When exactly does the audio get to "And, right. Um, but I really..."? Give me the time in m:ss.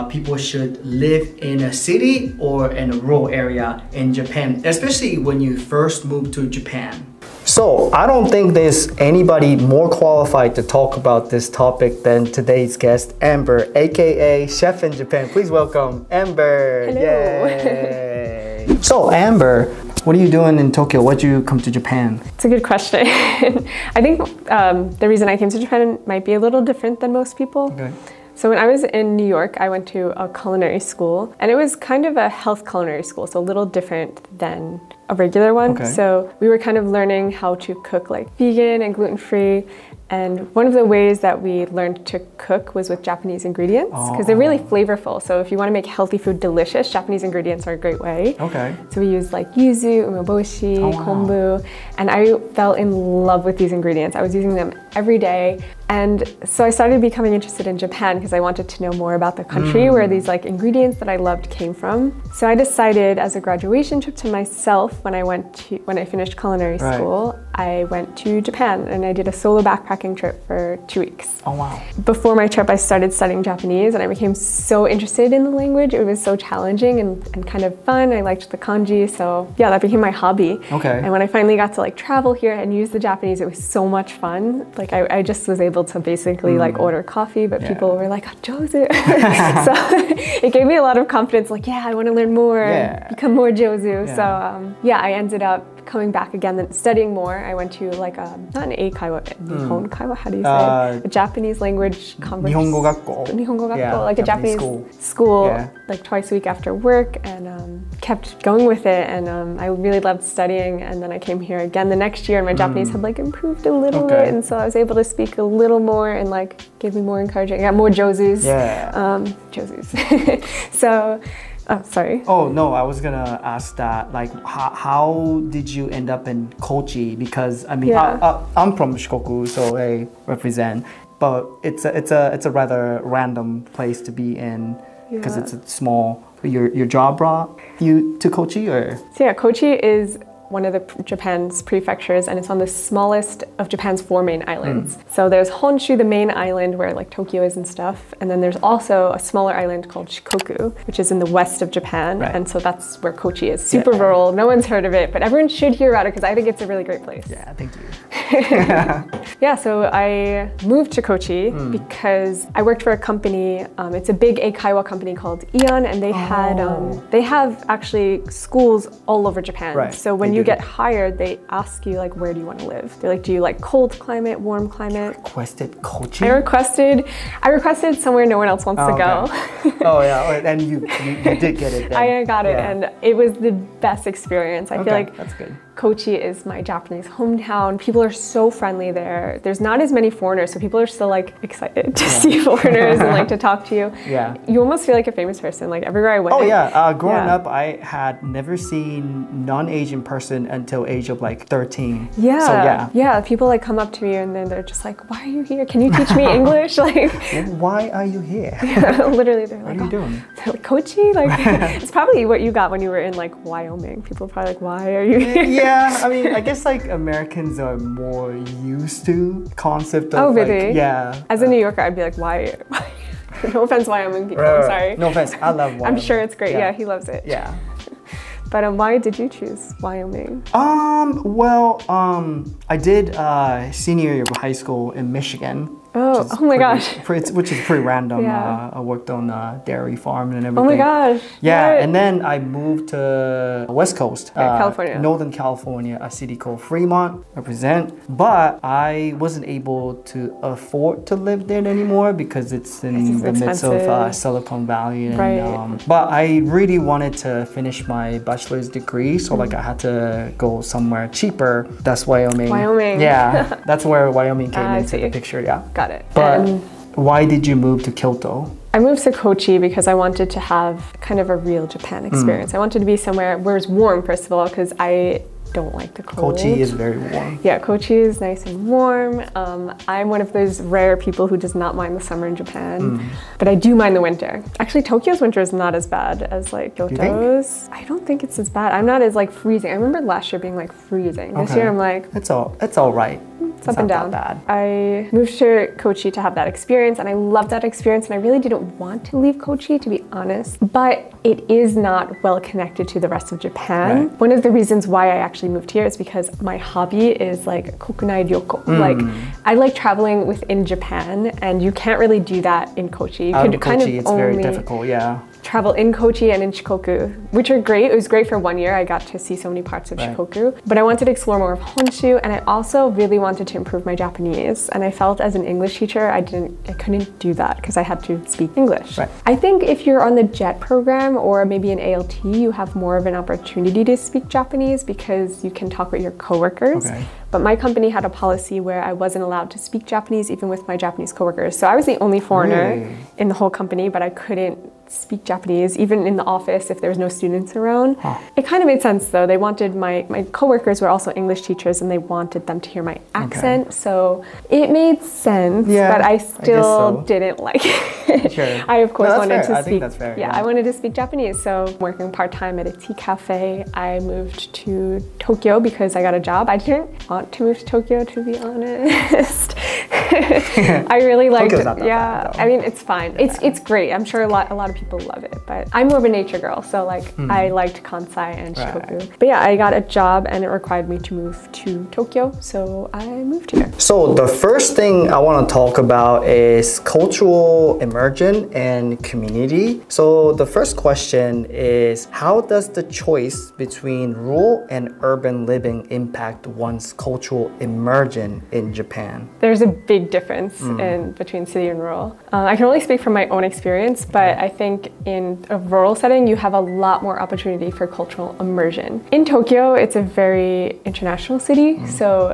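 4:15.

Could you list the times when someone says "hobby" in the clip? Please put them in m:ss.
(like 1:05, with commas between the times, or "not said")
1:20, 5:06.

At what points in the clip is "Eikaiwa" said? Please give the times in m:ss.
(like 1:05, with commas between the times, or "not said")
1:38, 2:44.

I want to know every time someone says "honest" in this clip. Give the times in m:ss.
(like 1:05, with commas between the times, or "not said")
5:00, 6:08.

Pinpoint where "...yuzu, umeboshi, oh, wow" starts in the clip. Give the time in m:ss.
0:49.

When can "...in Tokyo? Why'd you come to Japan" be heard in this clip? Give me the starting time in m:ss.
0:20.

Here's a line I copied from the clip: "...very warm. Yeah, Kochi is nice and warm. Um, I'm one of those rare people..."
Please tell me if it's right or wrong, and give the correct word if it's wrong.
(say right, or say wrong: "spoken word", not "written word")
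right.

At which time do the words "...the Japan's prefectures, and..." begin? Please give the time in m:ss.
2:20.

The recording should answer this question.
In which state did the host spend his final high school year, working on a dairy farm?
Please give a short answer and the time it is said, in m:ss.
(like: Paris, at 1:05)
Michigan, at 3:55.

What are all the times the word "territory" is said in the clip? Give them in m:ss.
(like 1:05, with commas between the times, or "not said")
not said.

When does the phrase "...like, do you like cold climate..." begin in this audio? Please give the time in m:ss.
2:53.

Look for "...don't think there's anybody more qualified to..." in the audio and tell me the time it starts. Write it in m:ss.
0:08.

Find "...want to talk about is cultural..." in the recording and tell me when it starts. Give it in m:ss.
6:25.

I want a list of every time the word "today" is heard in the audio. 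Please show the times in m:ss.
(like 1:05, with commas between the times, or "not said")
0:12.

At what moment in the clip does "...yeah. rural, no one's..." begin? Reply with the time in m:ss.
2:33.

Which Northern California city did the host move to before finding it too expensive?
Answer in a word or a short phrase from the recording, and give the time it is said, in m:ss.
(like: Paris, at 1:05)
Fremont, at 4:06.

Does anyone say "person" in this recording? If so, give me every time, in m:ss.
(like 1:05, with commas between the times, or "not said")
3:15, 3:20.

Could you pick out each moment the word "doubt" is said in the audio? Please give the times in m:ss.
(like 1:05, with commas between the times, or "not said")
not said.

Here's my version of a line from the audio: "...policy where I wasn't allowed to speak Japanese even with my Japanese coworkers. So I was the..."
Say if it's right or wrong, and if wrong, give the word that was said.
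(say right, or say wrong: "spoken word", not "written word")
right.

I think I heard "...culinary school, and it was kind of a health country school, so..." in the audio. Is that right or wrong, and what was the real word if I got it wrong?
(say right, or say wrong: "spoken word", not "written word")
wrong: "culinary", not "country".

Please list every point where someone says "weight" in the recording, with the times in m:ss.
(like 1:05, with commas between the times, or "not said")
not said.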